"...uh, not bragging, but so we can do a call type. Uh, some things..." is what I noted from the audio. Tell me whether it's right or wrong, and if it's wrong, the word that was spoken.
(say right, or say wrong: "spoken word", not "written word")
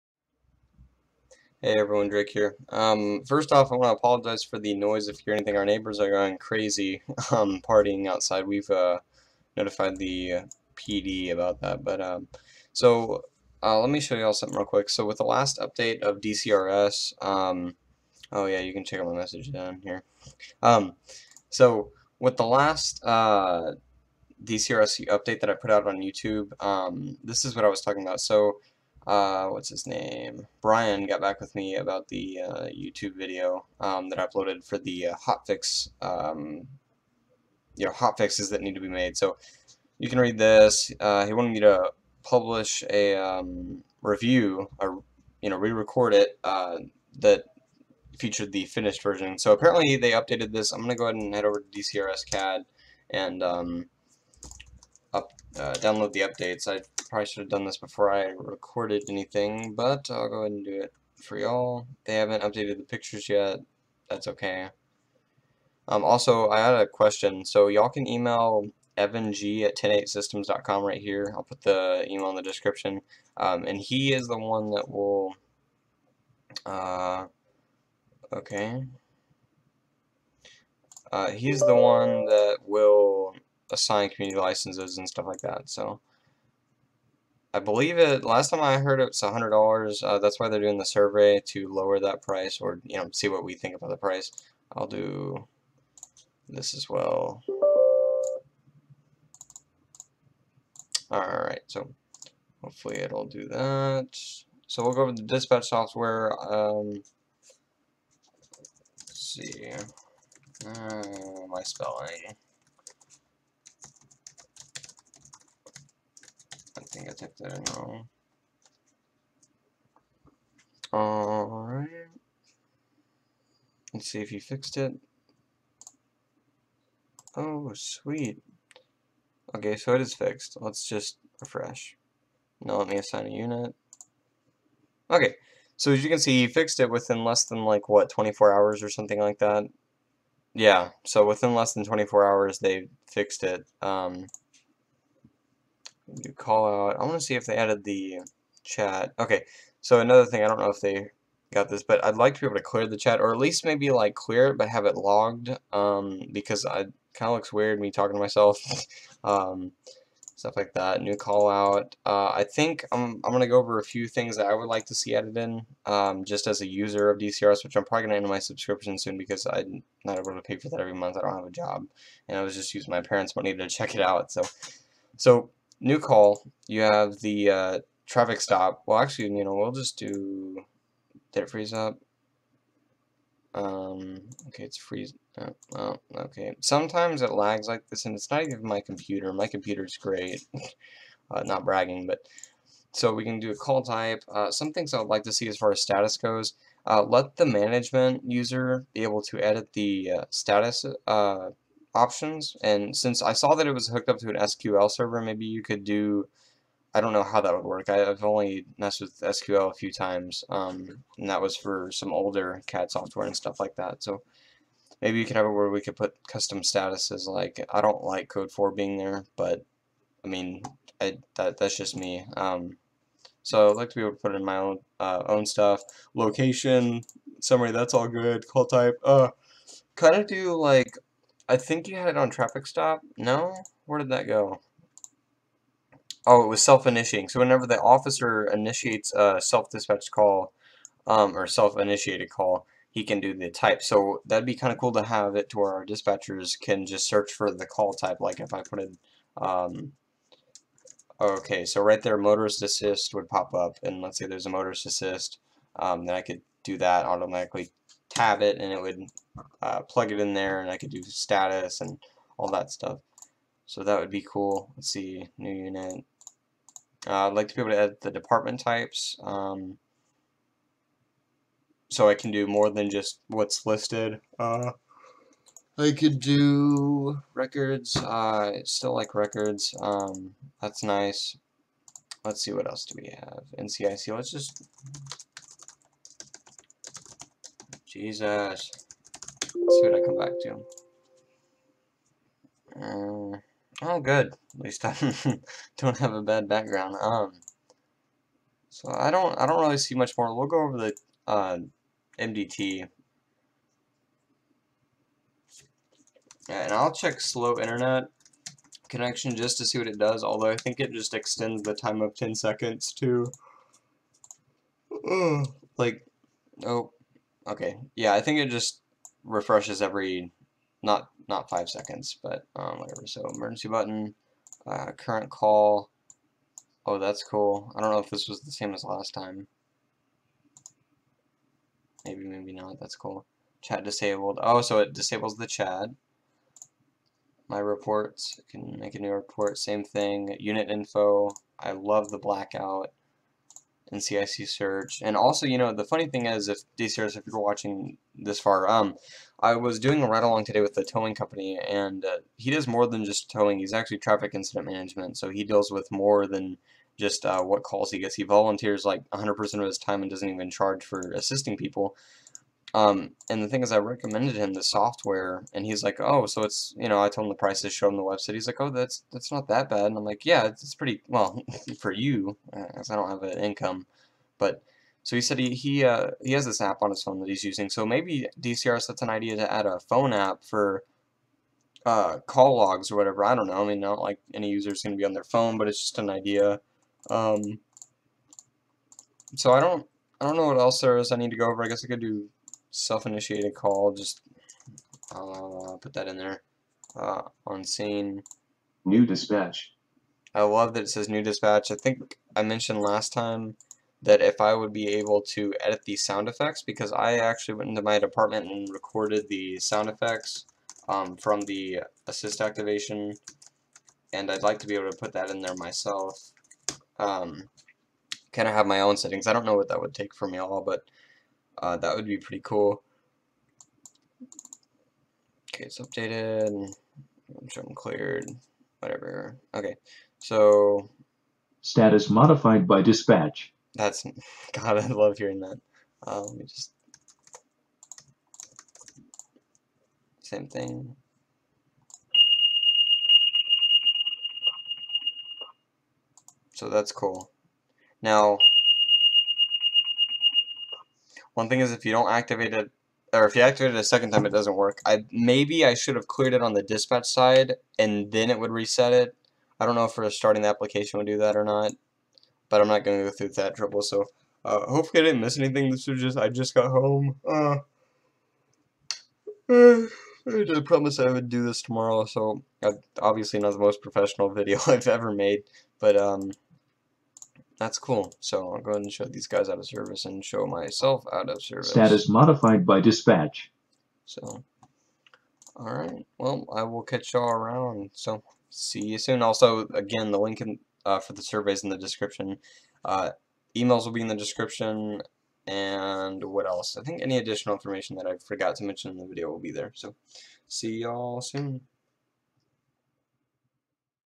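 right.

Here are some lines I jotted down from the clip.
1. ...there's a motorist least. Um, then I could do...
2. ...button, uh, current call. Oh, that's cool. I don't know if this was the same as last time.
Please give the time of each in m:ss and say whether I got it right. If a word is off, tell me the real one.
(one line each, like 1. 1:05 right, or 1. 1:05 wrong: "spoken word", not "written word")
1. 4:14 wrong: "assist", not "least"
2. 5:23 right.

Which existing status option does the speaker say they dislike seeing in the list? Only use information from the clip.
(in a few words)
Code 4.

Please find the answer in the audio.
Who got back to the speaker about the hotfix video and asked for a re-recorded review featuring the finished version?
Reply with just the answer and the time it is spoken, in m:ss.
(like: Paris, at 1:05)
Brian, at 0:30.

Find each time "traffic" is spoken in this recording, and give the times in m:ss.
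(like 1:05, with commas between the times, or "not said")
2:58, 3:52, 5:53.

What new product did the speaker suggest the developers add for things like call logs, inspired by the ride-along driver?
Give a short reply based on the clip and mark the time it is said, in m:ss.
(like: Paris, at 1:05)
Phone app, at 6:19.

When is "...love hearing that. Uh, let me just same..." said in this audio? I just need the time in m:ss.
7:14.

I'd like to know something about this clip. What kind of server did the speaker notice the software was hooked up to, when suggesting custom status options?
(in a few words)
SQL server.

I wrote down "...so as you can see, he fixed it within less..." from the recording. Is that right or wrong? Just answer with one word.
right.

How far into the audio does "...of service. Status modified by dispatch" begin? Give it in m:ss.
8:01.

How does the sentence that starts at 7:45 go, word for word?
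This was just, I just got home.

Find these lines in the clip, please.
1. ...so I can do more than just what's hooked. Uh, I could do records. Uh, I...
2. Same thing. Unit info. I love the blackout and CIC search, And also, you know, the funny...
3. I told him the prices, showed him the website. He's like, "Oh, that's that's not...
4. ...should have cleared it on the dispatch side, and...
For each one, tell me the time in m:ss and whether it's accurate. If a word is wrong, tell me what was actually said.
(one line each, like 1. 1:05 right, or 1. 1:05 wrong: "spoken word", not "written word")
1. 4:31 wrong: "listed", not "hooked"
2. 5:39 right
3. 6:07 right
4. 7:35 right.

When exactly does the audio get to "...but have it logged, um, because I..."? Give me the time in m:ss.
2:34.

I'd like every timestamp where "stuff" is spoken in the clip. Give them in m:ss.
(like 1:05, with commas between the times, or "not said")
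1:25, 2:40, 3:33, 3:45, 4:22.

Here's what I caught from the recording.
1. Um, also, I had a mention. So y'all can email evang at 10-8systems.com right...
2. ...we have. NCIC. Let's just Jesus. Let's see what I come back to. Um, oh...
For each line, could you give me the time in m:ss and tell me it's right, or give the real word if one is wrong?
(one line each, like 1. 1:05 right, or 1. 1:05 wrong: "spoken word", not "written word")
1. 1:05 wrong: "question", not "mention"
2. 4:43 right.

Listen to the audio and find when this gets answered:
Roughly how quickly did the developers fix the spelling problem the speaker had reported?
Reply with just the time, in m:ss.
2:21.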